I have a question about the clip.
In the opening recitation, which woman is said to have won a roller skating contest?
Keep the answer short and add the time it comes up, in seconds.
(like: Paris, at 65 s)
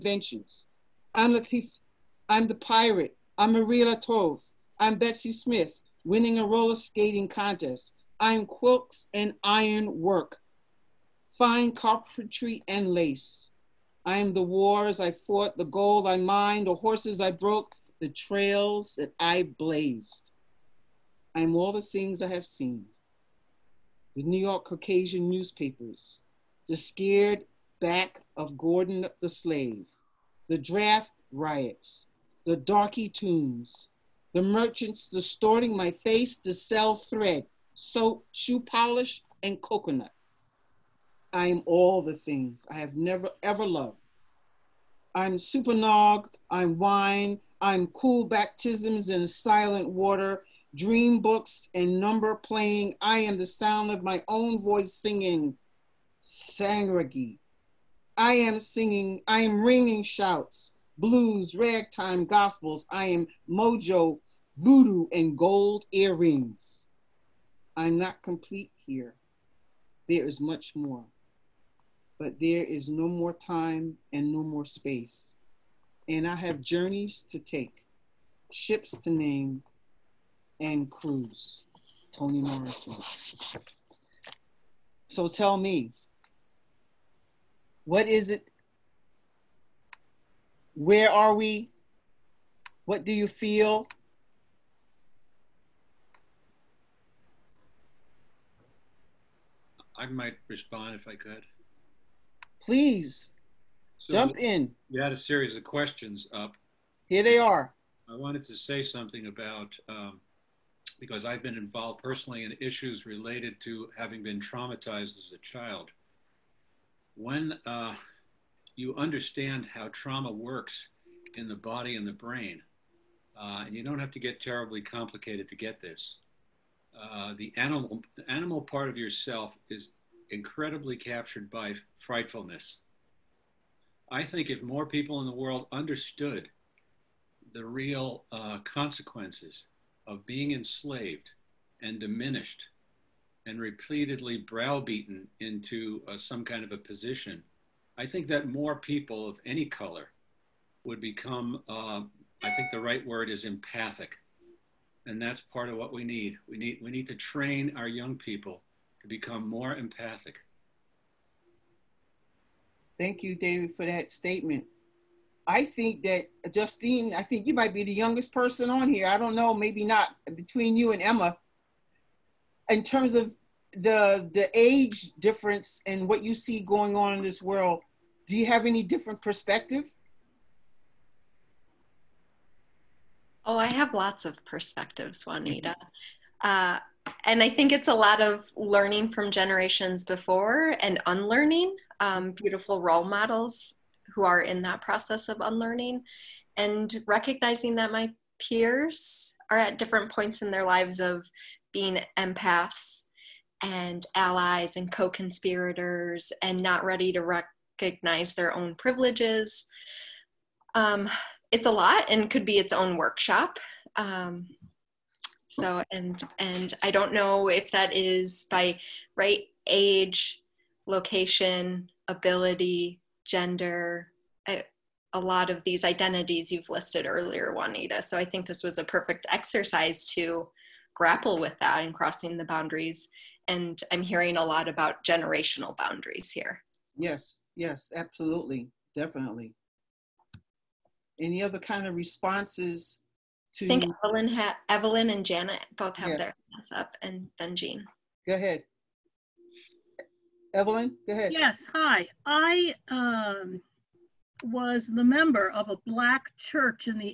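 Betsy Smith, at 4 s.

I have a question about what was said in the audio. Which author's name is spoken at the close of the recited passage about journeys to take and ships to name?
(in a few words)
Toni Morrison.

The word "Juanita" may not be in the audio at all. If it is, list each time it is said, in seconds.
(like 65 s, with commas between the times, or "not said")
185 s, 227 s.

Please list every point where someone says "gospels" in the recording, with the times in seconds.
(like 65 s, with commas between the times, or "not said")
62 s.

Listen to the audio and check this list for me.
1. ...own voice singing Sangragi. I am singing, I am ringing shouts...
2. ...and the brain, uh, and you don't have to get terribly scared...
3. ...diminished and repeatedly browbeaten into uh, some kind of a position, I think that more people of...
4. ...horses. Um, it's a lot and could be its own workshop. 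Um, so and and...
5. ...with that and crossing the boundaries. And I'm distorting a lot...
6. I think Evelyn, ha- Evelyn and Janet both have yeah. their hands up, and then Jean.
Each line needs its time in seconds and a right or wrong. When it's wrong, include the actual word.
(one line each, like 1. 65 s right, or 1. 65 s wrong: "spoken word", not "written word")
1. 54 s right
2. 121 s wrong: "complicated", not "scared"
3. 141 s right
4. 208 s wrong: "privileges", not "horses"
5. 231 s wrong: "hearing", not "distorting"
6. 243 s right.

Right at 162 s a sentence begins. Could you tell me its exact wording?
Thank you, David, for that statement.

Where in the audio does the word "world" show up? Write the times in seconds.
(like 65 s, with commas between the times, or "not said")
135 s, 177 s.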